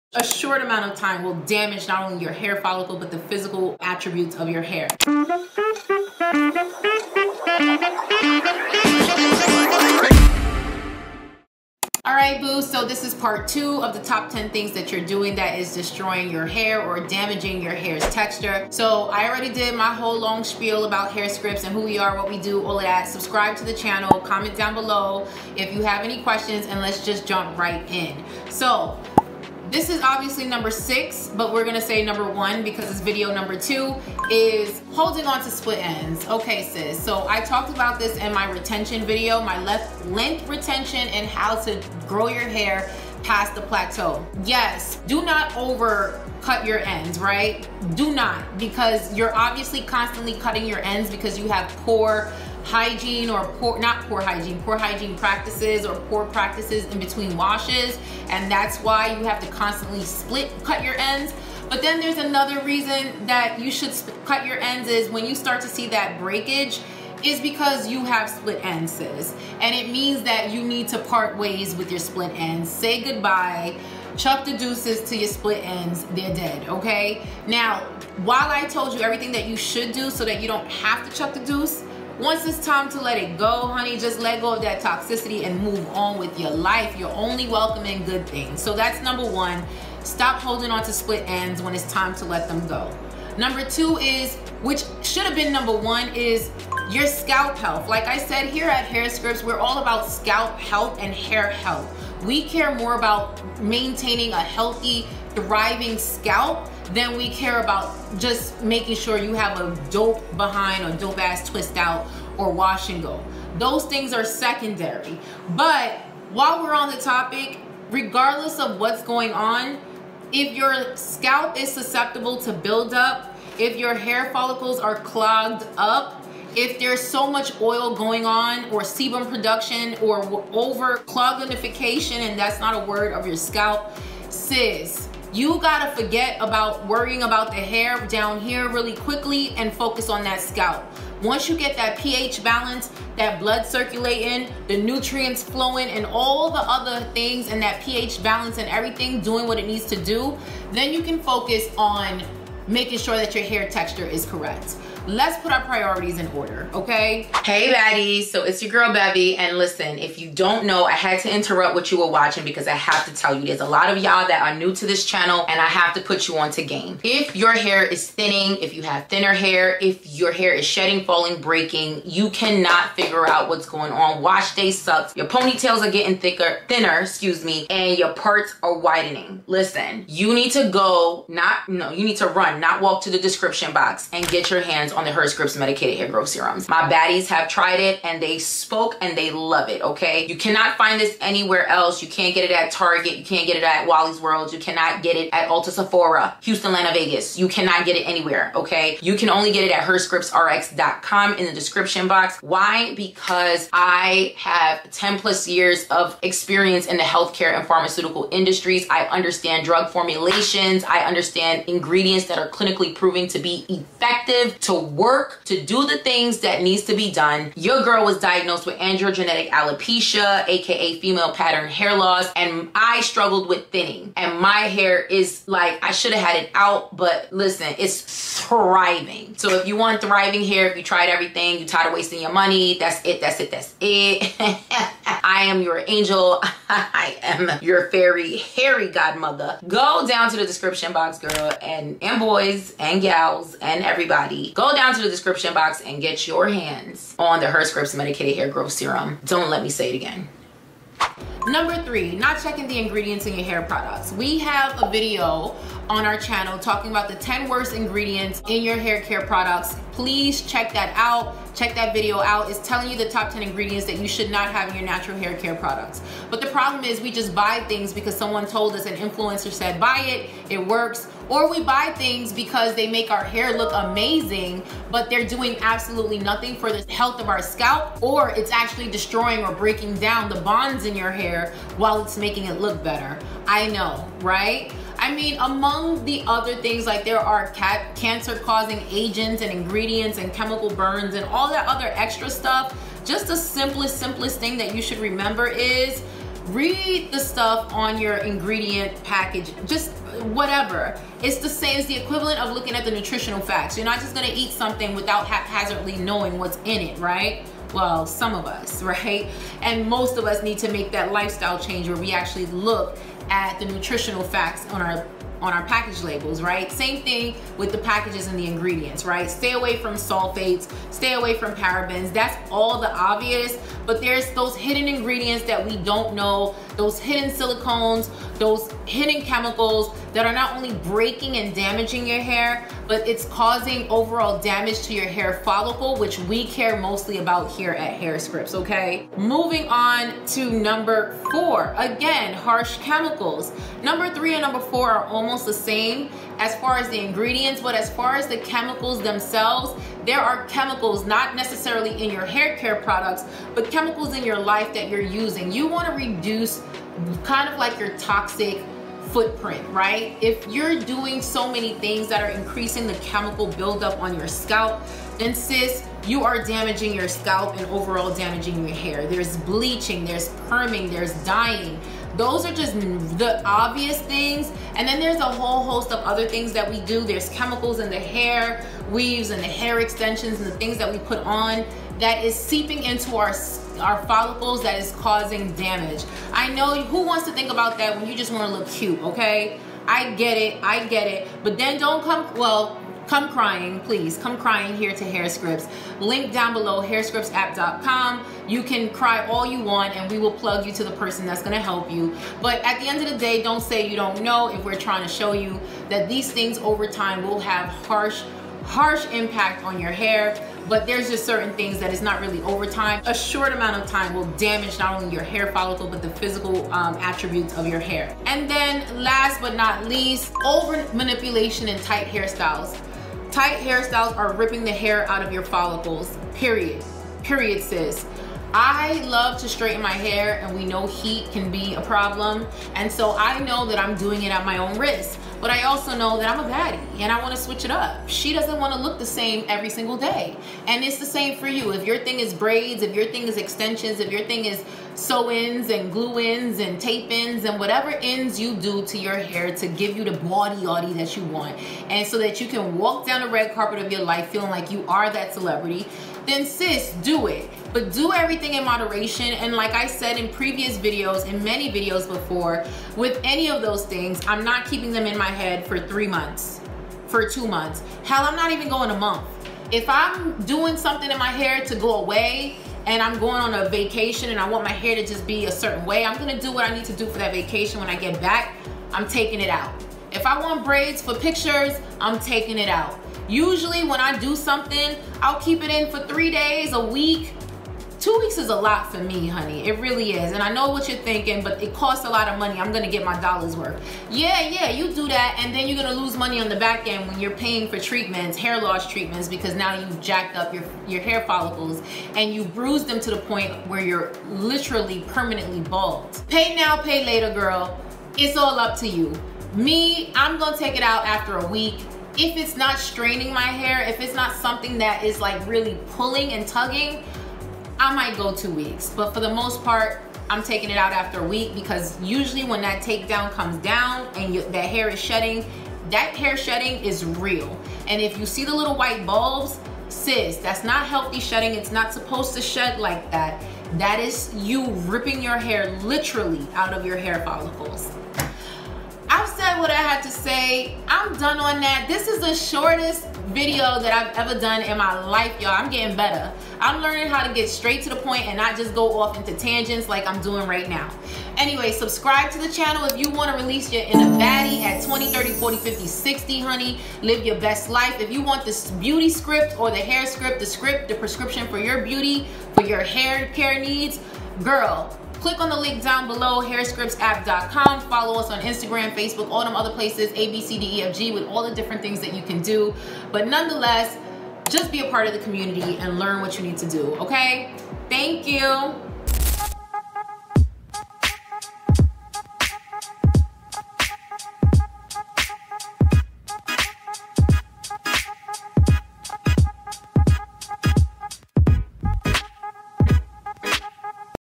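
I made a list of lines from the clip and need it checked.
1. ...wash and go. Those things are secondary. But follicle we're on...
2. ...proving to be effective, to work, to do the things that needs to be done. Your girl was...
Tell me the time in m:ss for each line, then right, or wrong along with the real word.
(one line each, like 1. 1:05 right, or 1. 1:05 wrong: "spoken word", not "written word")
1. 1:52 wrong: "while", not "follicle"
2. 3:32 right.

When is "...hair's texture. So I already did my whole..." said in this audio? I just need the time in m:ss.
0:17.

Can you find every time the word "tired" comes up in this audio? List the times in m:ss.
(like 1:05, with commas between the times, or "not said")
3:51.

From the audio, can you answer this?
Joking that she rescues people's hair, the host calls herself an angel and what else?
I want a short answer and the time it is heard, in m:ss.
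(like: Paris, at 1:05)
Fairy hairy godmother, at 3:57.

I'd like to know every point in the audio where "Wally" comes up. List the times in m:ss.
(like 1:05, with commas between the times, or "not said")
3:13.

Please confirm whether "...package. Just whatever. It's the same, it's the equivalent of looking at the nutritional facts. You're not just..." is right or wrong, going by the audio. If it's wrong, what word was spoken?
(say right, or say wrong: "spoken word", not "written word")
right.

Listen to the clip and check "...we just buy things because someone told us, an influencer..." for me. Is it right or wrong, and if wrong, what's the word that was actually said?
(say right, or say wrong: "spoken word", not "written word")
right.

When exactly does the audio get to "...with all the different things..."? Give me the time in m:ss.
9:31.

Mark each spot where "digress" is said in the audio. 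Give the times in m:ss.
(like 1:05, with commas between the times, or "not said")
not said.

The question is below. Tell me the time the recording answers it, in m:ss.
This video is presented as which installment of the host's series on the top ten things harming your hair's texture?
0:13.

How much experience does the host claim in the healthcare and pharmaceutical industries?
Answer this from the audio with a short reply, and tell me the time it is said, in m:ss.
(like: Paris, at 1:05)
10 plus years, at 3:24.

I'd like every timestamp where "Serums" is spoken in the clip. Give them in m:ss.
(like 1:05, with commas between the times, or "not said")
3:06, 4:08.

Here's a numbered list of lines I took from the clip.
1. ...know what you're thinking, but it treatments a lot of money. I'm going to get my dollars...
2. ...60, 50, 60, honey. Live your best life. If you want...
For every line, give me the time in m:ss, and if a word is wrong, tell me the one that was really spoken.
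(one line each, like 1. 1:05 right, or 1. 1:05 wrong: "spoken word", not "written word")
1. 8:10 wrong: "costs", not "treatments"
2. 9:15 wrong: "40", not "60".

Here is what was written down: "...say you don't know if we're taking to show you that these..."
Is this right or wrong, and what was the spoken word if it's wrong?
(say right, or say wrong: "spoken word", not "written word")
wrong: "trying", not "taking".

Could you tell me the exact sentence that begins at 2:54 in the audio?
Wash day sucks, your ponytails are getting thicker, thinner, excuse me, and your parts are widening.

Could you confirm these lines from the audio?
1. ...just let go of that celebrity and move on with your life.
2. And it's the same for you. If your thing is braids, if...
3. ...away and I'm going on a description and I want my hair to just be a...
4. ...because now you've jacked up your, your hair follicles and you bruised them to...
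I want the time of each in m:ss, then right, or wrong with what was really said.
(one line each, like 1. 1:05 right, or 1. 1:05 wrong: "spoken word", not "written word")
1. 1:23 wrong: "toxicity", not "celebrity"
2. 7:20 right
3. 7:51 wrong: "vacation", not "description"
4. 8:19 right.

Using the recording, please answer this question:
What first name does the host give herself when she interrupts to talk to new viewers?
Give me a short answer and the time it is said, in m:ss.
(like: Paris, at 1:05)
Bevy, at 2:38.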